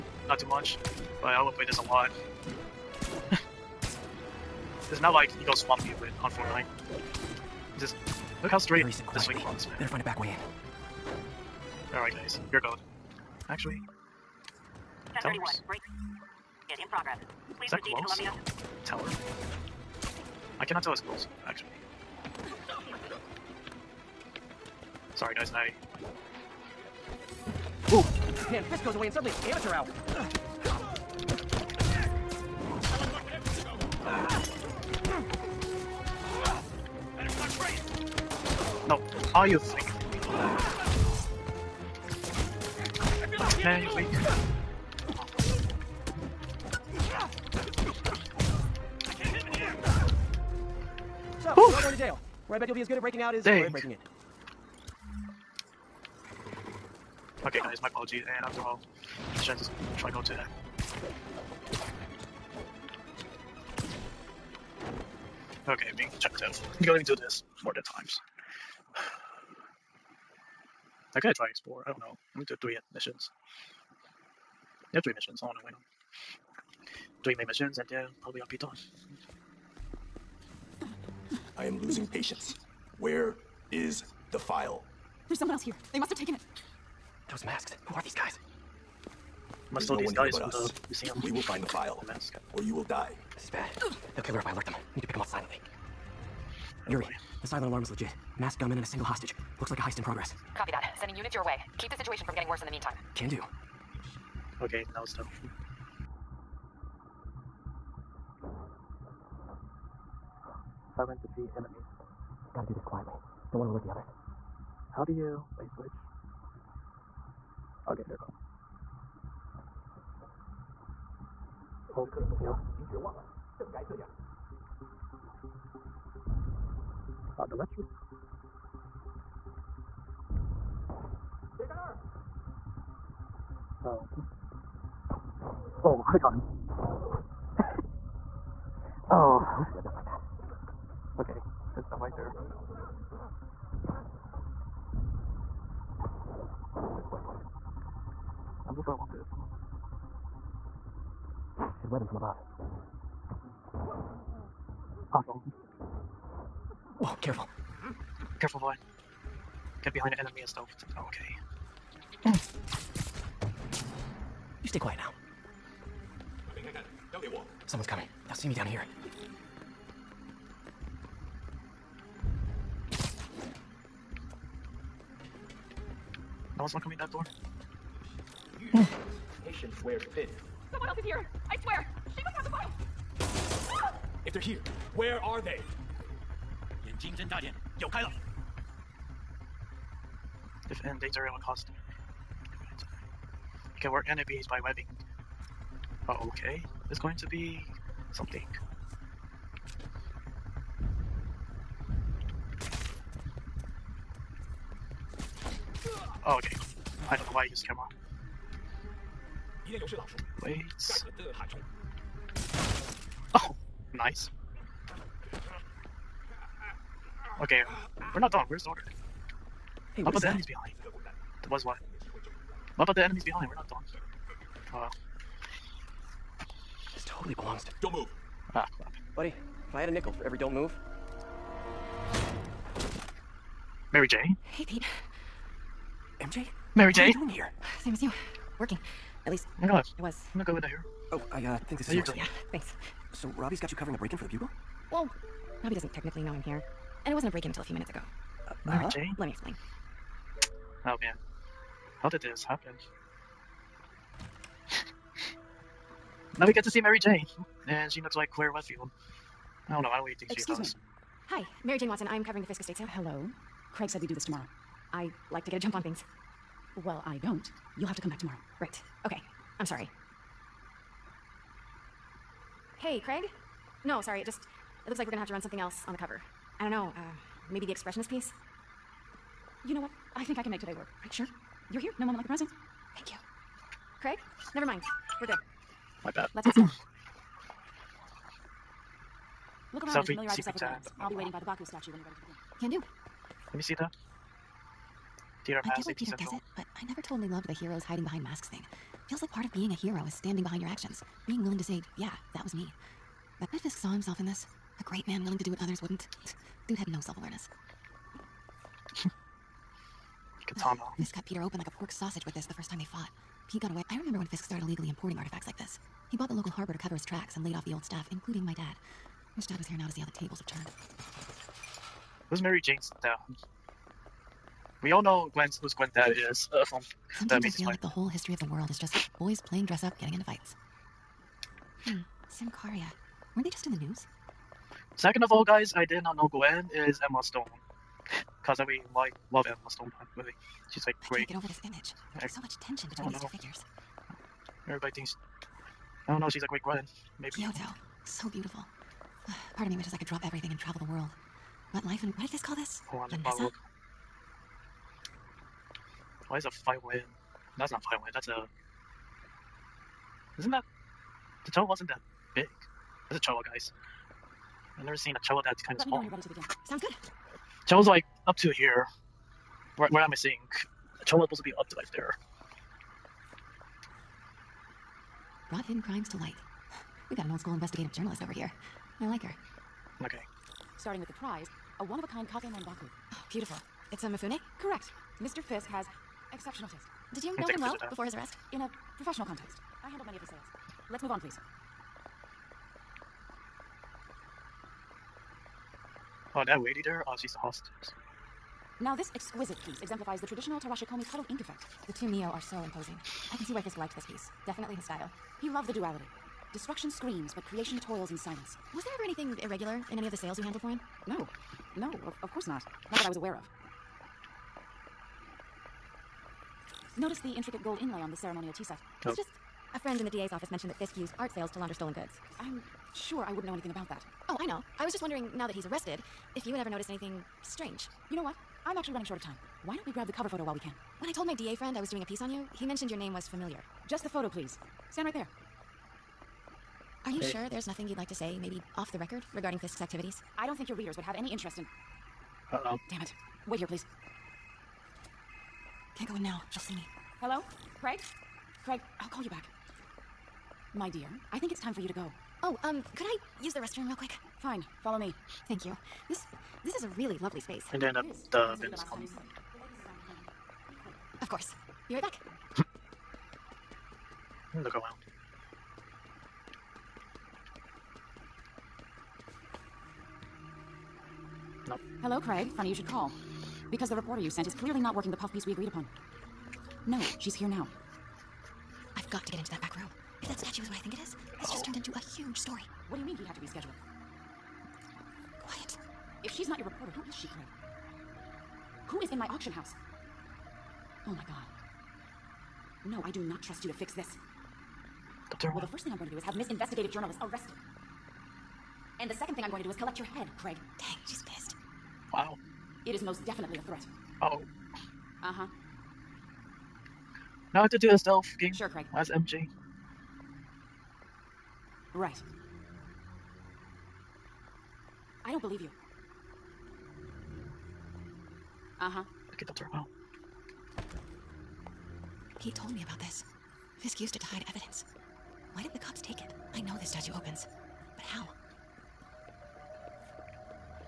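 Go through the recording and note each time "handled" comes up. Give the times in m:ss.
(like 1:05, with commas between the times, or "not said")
6:29, 6:50.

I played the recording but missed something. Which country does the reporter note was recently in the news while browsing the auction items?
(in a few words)
Symkaria.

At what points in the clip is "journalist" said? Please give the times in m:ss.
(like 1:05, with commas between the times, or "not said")
6:17, 8:16.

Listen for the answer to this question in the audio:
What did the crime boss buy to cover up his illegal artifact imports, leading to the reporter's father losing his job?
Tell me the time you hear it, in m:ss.
5:16.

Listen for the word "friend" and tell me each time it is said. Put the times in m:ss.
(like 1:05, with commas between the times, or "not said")
6:59, 7:11.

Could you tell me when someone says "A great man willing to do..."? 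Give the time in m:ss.
5:04.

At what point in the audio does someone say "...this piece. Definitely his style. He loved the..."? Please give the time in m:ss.
6:43.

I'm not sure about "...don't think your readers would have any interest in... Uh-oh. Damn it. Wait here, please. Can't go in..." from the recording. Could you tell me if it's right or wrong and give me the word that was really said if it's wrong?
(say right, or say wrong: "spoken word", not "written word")
right.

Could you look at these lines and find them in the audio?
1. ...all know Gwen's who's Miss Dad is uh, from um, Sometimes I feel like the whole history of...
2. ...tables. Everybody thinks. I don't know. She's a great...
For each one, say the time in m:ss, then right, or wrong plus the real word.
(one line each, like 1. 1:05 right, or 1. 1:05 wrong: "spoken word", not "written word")
1. 5:24 wrong: "Gwen", not "Miss"
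2. 5:43 wrong: "figures", not "tables".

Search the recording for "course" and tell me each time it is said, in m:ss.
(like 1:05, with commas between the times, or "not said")
6:52, 7:41.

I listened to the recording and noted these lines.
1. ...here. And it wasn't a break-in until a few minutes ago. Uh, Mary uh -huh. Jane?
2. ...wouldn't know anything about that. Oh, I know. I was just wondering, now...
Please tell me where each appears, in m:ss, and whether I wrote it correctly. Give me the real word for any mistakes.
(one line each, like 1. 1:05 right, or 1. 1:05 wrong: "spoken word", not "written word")
1. 4:06 right
2. 7:03 right.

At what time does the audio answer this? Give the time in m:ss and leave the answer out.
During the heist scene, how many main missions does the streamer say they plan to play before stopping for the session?
1:17.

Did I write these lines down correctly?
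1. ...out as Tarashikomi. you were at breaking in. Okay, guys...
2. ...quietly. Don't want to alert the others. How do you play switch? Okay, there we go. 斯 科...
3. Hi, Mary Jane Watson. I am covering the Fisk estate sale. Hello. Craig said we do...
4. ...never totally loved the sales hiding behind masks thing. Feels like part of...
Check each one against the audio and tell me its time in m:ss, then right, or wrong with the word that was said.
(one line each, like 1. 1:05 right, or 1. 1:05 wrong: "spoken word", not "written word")
1. 0:53 wrong: "Dang", not "Tarashikomi"
2. 1:52 right
3. 4:21 right
4. 4:56 wrong: "heroes", not "sales".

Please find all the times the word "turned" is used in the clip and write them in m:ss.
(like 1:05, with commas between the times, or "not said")
5:20, 8:01.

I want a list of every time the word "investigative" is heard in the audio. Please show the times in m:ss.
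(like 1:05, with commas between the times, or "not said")
6:17, 8:16.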